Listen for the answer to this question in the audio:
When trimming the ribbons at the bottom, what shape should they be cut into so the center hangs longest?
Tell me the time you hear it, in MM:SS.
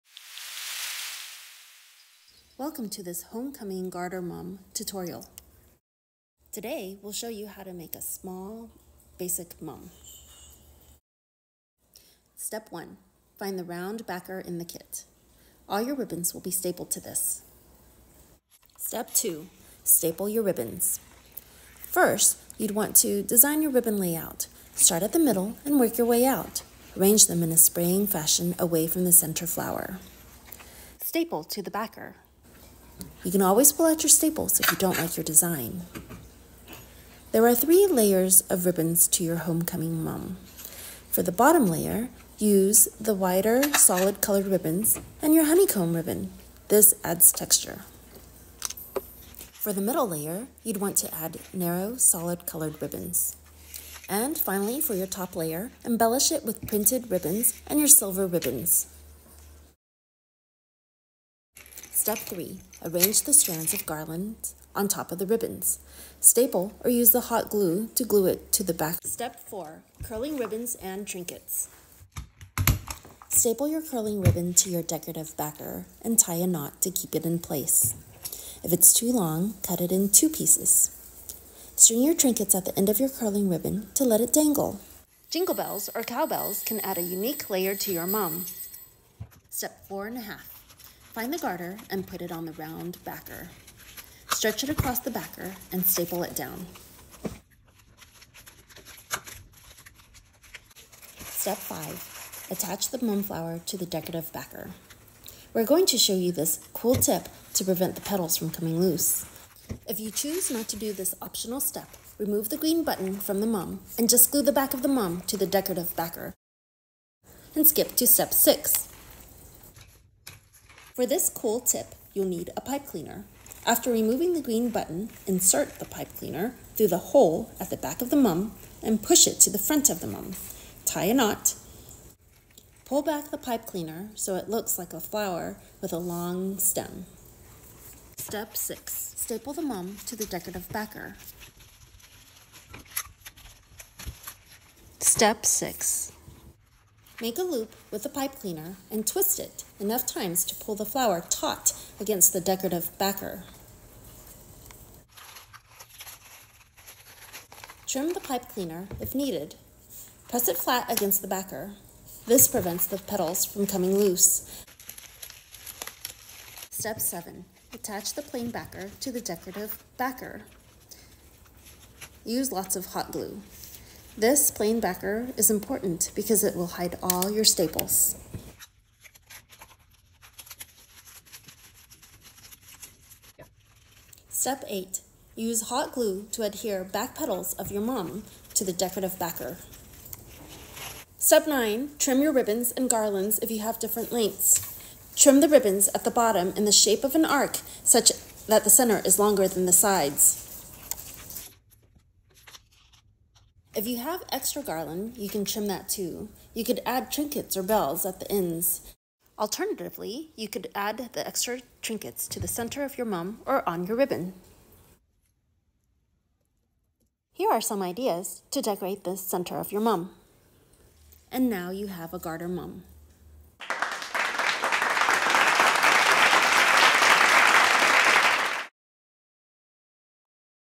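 03:17.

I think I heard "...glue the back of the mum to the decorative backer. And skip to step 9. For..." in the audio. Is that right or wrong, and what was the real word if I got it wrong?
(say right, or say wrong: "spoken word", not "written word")
wrong: "6", not "9".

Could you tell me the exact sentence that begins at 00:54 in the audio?
And finally, for your top layer, embellish it with printed ribbons and your silver ribbons.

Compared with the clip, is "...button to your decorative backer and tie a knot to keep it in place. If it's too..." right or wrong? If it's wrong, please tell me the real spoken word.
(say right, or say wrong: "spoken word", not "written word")
wrong: "ribbon", not "button".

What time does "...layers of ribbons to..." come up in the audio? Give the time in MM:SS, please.
00:37.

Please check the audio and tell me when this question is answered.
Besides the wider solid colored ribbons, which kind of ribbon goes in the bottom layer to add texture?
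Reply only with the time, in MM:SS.
00:45.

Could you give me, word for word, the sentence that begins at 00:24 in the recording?
Start at the middle and work your way out.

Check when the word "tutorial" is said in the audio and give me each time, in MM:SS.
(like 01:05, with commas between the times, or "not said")
00:04.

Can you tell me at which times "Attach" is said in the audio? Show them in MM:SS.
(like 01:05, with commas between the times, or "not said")
01:42, 02:47.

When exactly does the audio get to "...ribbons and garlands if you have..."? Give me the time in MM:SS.
03:12.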